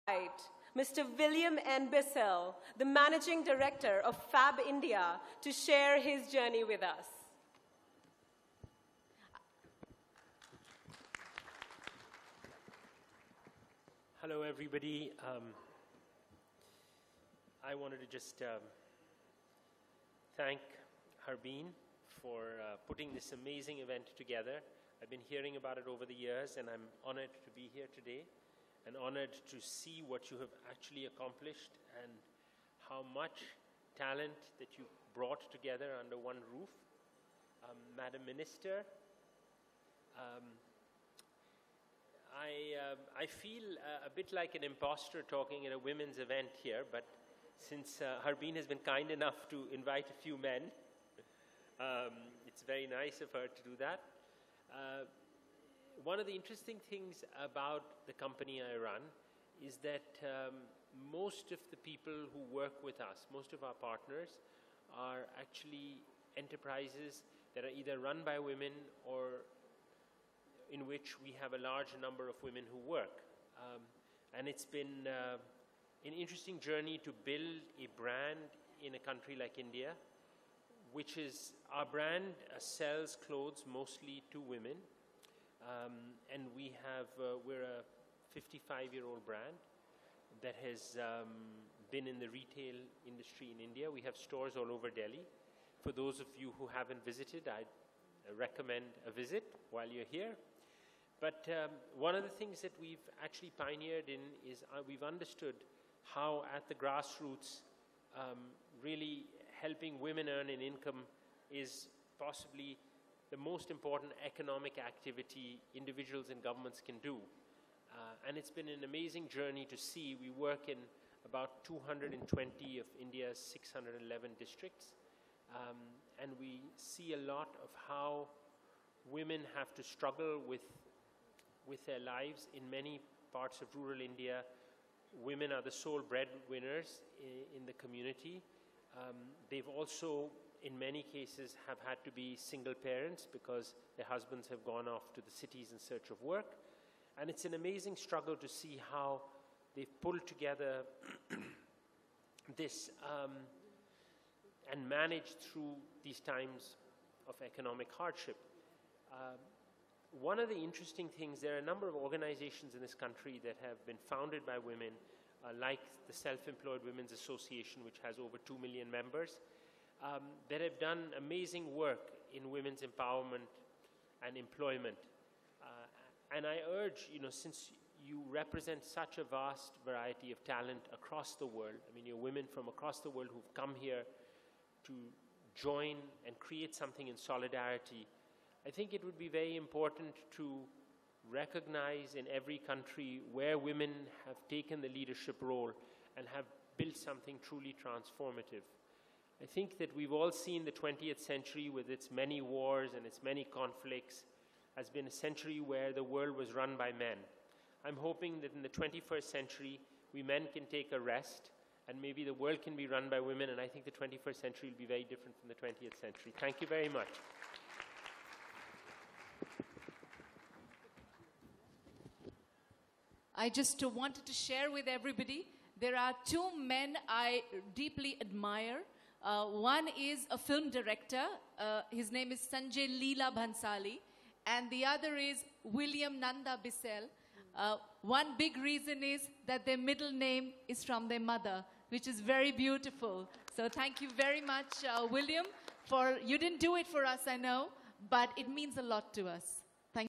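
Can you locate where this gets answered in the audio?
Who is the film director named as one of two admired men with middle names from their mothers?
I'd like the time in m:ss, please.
3:52.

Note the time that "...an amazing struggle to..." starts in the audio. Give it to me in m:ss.
2:27.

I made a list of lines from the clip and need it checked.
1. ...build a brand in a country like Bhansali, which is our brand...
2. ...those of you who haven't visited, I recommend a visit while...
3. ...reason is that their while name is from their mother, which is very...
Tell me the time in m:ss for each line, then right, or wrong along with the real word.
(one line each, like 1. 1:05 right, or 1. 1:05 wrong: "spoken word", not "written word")
1. 1:17 wrong: "India", not "Bhansali"
2. 1:35 right
3. 3:58 wrong: "middle", not "while".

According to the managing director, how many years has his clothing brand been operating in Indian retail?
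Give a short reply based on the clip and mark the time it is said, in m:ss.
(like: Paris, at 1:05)
55, at 1:28.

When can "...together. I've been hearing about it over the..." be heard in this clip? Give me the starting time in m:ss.
0:24.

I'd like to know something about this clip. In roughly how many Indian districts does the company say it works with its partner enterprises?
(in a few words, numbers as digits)
220.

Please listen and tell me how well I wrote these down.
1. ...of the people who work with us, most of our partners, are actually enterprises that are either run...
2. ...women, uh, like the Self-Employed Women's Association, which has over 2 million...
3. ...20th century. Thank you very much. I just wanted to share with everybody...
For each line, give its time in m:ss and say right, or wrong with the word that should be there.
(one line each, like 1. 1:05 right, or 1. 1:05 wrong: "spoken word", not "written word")
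1. 1:01 right
2. 2:44 right
3. 3:35 right.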